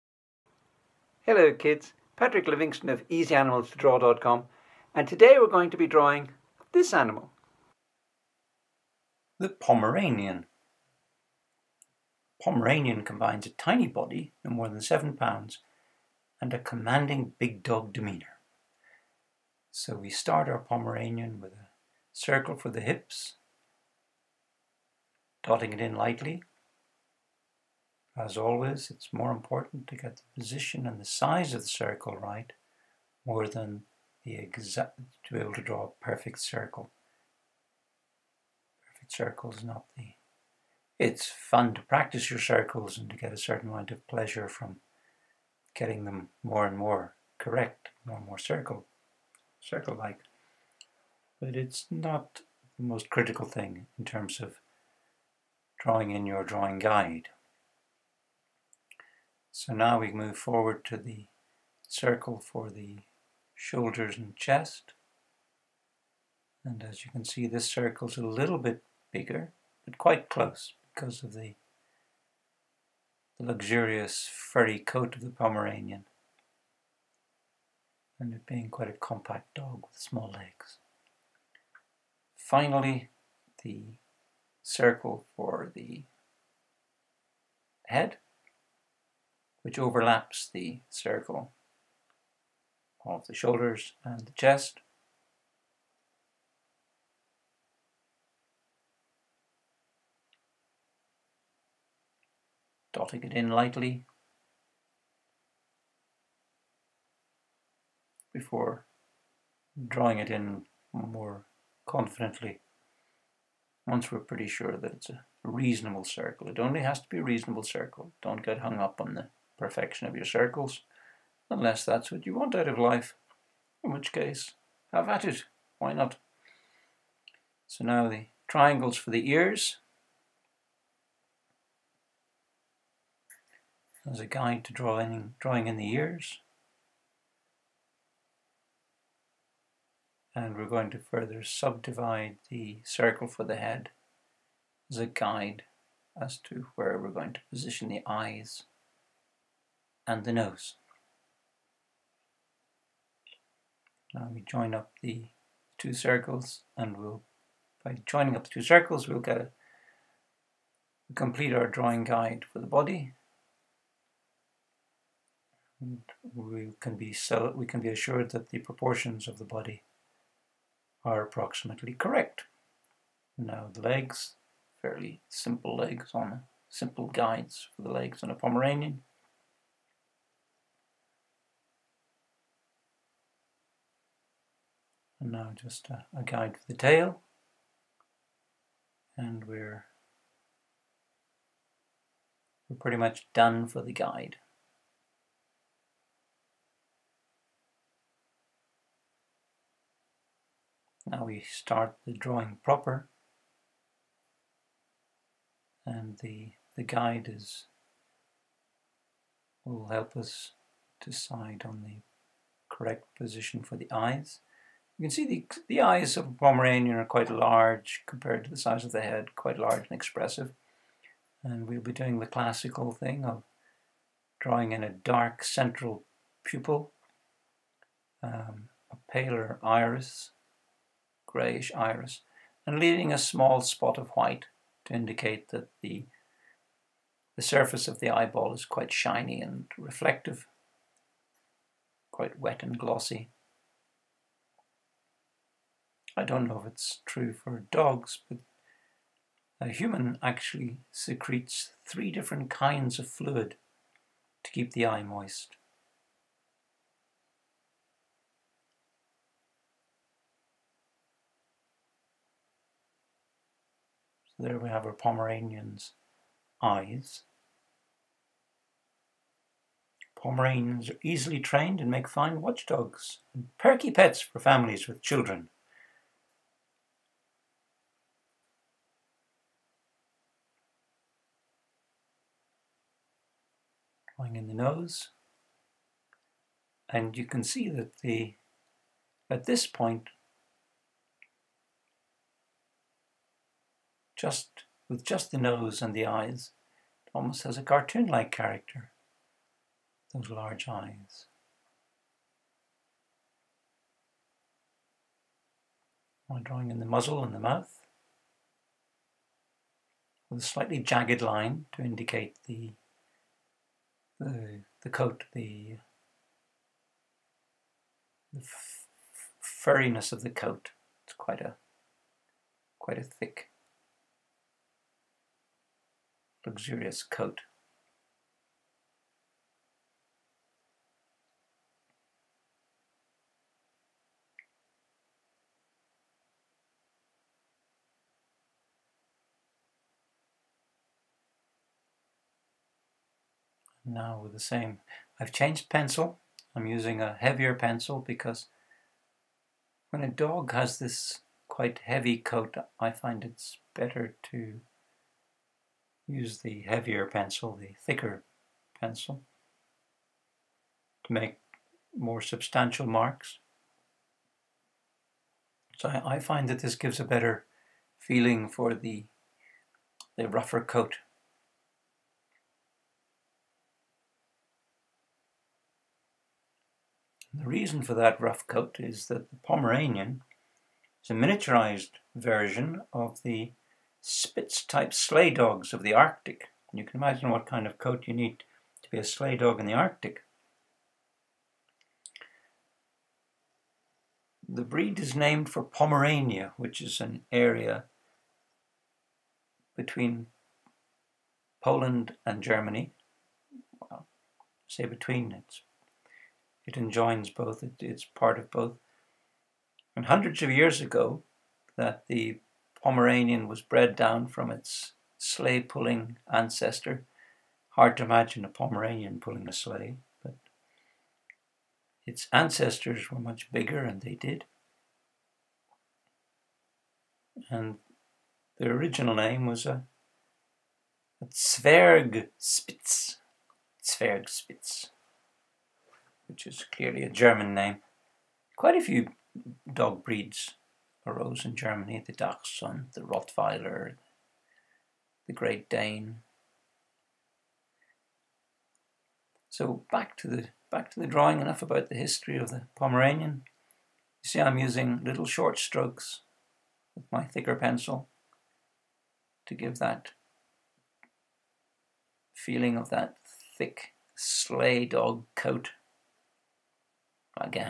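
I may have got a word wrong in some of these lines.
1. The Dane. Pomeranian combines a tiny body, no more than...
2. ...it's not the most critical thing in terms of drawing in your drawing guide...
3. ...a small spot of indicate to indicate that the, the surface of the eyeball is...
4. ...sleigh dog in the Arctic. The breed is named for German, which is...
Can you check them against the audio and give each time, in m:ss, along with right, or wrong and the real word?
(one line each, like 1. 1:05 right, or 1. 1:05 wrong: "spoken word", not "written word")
1. 0:09 wrong: "Pomeranian", not "Dane"
2. 0:51 right
3. 3:53 wrong: "white", not "indicate"
4. 6:29 wrong: "Pomerania", not "German".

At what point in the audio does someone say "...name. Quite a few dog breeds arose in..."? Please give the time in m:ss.
7:17.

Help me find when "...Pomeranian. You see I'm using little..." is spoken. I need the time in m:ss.
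7:32.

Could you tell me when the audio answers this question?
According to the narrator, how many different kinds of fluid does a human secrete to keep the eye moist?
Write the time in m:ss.
4:11.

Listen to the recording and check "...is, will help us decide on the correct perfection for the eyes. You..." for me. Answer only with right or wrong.
wrong.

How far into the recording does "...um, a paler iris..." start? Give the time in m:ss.
3:48.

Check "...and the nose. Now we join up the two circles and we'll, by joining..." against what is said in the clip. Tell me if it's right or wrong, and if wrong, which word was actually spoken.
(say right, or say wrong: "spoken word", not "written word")
right.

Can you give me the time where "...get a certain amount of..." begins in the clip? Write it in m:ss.
0:43.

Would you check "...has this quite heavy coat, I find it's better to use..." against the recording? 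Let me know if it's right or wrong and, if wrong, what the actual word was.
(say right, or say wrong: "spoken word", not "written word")
right.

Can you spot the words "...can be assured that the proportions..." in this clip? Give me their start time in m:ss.
2:47.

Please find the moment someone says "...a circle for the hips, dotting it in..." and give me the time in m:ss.
0:21.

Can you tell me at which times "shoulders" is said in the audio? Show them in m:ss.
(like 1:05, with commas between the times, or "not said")
1:03, 1:33.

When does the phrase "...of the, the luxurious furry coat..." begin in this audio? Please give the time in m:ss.
1:11.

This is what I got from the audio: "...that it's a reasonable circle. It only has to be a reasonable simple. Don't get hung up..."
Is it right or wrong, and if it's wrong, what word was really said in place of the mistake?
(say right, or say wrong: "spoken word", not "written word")
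wrong: "circle", not "simple".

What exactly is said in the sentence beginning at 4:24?
So there we have our Pomeranian's eyes.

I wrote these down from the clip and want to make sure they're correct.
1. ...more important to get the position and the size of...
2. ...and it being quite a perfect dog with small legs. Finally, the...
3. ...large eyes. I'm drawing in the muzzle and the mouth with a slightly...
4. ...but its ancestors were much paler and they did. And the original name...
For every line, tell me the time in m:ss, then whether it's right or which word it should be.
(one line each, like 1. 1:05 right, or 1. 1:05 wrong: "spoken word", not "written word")
1. 0:29 right
2. 1:18 wrong: "compact", not "perfect"
3. 5:00 right
4. 7:00 wrong: "bigger", not "paler".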